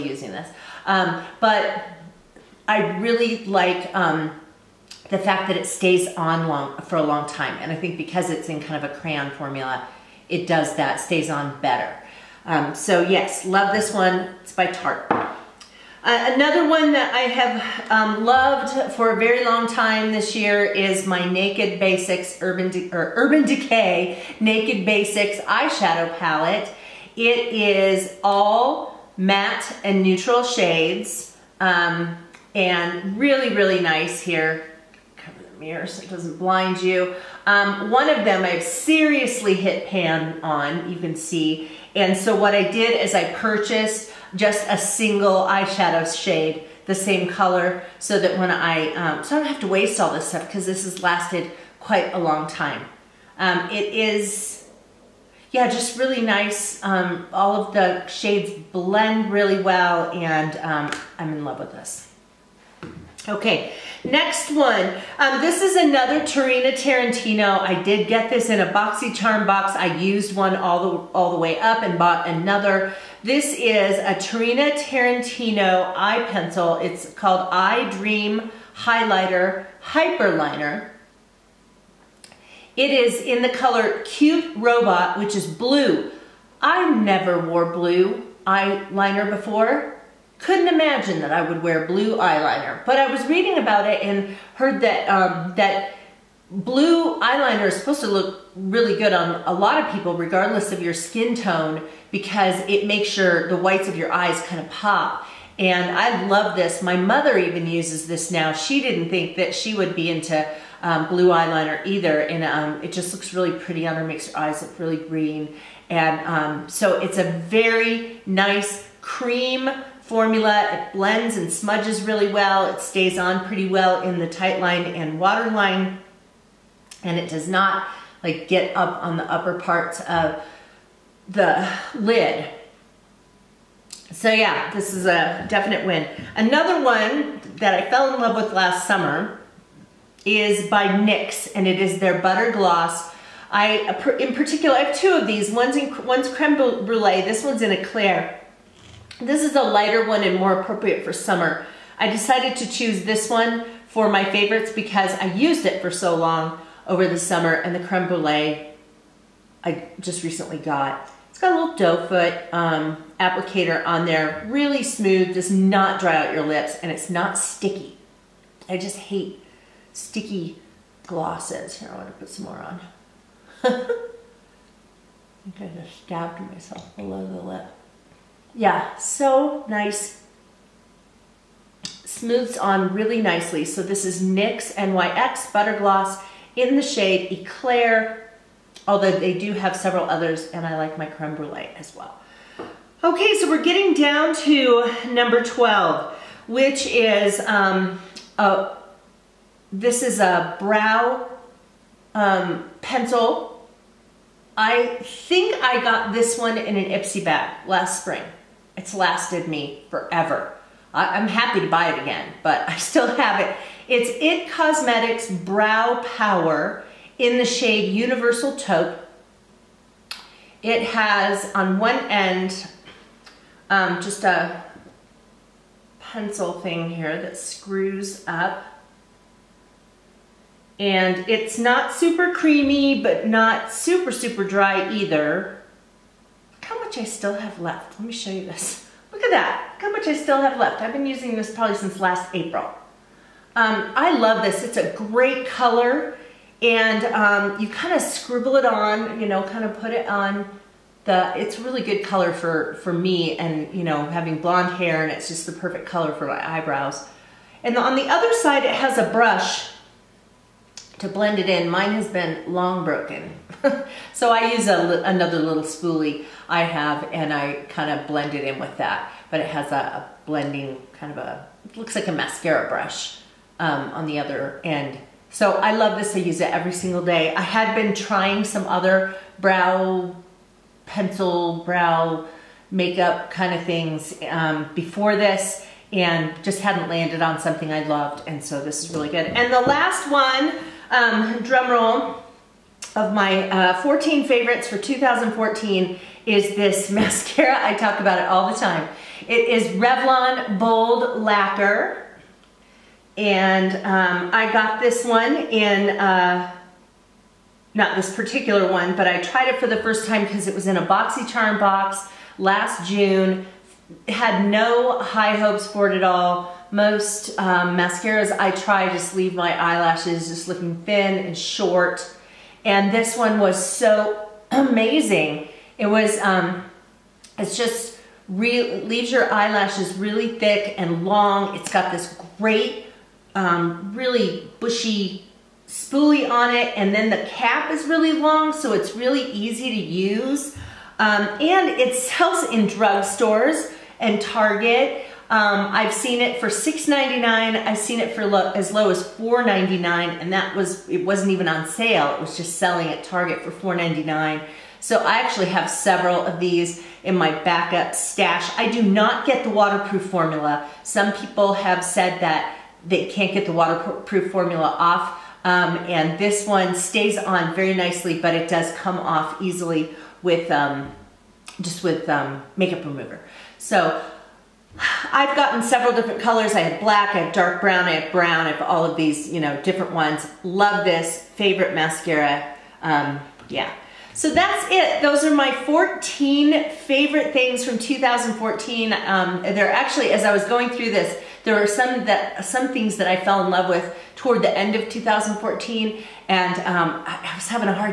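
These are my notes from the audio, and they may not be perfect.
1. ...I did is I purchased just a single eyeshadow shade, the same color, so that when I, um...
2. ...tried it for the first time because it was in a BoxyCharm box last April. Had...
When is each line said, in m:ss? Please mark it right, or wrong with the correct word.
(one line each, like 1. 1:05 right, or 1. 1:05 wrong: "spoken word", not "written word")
1. 0:42 right
2. 5:09 wrong: "June", not "April".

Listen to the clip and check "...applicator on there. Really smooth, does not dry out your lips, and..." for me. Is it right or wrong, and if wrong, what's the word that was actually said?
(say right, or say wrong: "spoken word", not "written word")
right.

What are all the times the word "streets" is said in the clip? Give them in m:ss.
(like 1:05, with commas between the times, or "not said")
not said.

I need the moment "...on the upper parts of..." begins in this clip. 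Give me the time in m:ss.
2:09.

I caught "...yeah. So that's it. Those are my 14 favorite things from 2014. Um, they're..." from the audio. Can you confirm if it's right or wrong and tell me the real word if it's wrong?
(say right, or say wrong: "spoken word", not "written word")
right.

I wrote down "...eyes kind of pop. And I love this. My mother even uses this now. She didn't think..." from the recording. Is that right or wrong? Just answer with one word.
right.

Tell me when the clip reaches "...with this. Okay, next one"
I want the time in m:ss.
1:01.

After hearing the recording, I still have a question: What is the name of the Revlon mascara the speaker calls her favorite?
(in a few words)
Bold Lacquer.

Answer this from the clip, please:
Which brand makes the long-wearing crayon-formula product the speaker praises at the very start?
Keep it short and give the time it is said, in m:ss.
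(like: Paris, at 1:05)
Tarte, at 0:14.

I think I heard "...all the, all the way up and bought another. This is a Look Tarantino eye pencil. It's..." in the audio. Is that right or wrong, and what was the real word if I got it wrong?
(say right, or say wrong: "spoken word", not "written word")
wrong: "Tarina", not "Look".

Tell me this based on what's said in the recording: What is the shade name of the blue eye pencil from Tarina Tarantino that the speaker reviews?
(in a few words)
Cute Robot.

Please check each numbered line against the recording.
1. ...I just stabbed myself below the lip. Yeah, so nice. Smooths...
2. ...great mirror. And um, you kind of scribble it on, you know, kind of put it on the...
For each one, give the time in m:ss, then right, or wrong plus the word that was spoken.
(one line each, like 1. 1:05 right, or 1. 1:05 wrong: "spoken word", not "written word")
1. 2:55 right
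2. 4:04 wrong: "color", not "mirror".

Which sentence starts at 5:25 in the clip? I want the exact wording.
It was, um, it's just, real, leaves your eyelashes really thick and long.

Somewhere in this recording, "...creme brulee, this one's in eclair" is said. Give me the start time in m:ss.
2:26.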